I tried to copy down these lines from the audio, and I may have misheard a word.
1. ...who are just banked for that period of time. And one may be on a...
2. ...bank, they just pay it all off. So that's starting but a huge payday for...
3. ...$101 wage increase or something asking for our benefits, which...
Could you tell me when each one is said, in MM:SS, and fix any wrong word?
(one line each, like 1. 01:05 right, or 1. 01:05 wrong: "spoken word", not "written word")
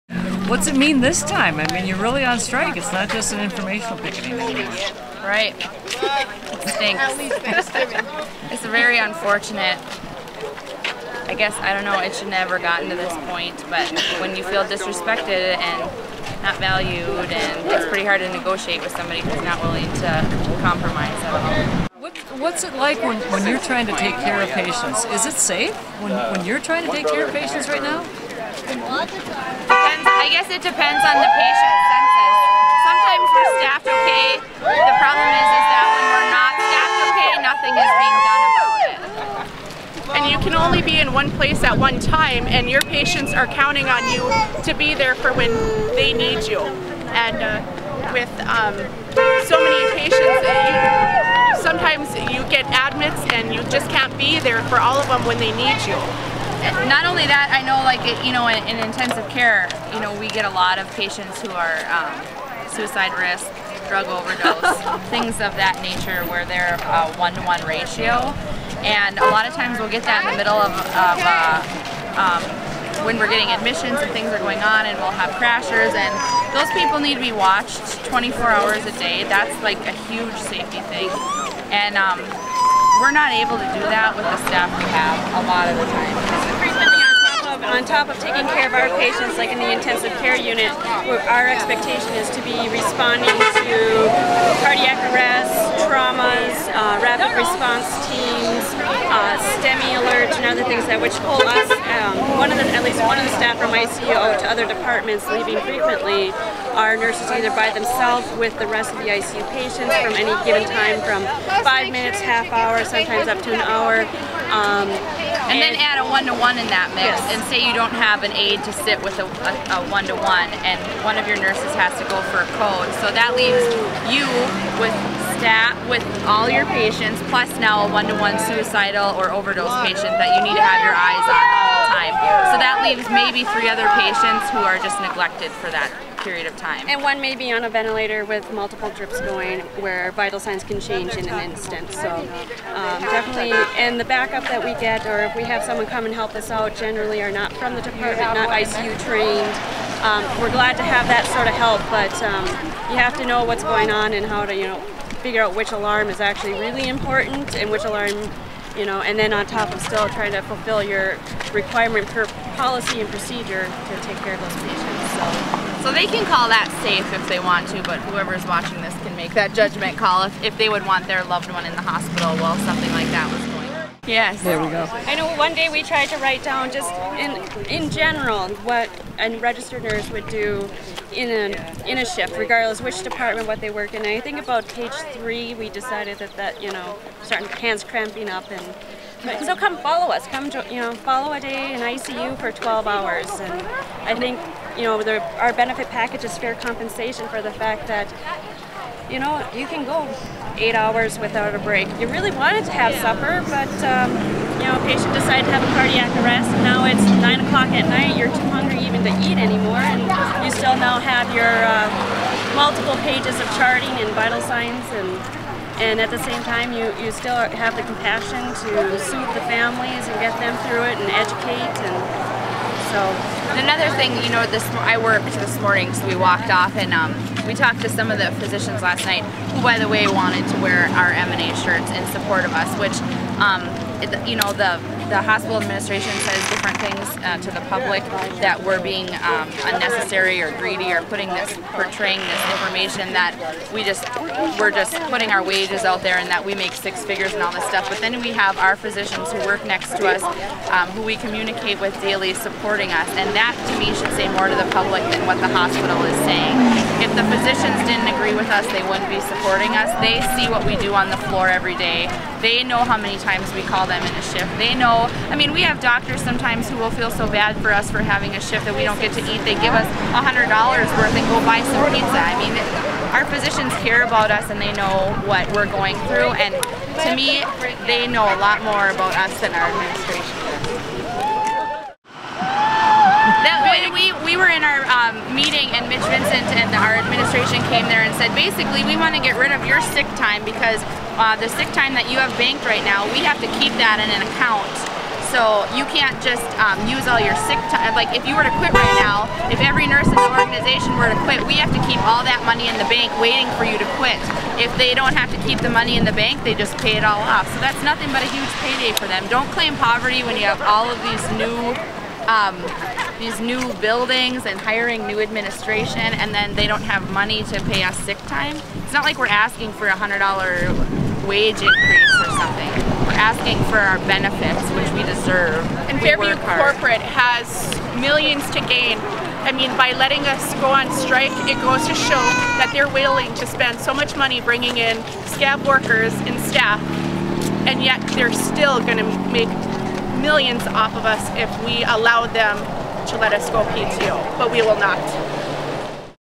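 1. 02:14 wrong: "neglected", not "banked"
2. 05:06 wrong: "nothing", not "starting"
3. 05:19 wrong: "100", not "101".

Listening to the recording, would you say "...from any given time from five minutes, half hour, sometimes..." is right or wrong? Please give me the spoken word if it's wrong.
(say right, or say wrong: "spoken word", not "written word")
right.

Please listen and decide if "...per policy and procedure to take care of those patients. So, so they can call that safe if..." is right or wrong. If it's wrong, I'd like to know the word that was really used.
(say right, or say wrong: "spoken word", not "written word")
right.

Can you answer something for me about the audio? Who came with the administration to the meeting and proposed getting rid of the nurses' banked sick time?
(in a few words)
Mitch Vincent.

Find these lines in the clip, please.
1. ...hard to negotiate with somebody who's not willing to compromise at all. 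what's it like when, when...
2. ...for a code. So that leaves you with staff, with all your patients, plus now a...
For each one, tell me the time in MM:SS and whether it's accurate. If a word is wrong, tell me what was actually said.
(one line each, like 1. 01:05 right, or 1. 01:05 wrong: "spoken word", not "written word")
1. 00:18 right
2. 02:02 right.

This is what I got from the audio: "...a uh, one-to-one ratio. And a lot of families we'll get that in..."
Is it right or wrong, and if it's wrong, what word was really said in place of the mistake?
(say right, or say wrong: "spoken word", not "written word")
wrong: "times", not "families".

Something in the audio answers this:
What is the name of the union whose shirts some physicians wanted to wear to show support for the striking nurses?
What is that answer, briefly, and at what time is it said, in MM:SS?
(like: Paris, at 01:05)
MNA, at 03:51.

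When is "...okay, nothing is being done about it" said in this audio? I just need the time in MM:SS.
00:37.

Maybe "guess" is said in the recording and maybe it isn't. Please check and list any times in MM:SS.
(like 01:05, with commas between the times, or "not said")
00:11, 00:30.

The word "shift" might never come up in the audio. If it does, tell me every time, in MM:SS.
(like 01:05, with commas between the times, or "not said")
03:02, 04:24, 04:28.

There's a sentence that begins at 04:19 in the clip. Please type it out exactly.
They see what we do on the floor every day.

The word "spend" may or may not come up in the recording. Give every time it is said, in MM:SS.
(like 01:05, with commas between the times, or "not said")
05:33.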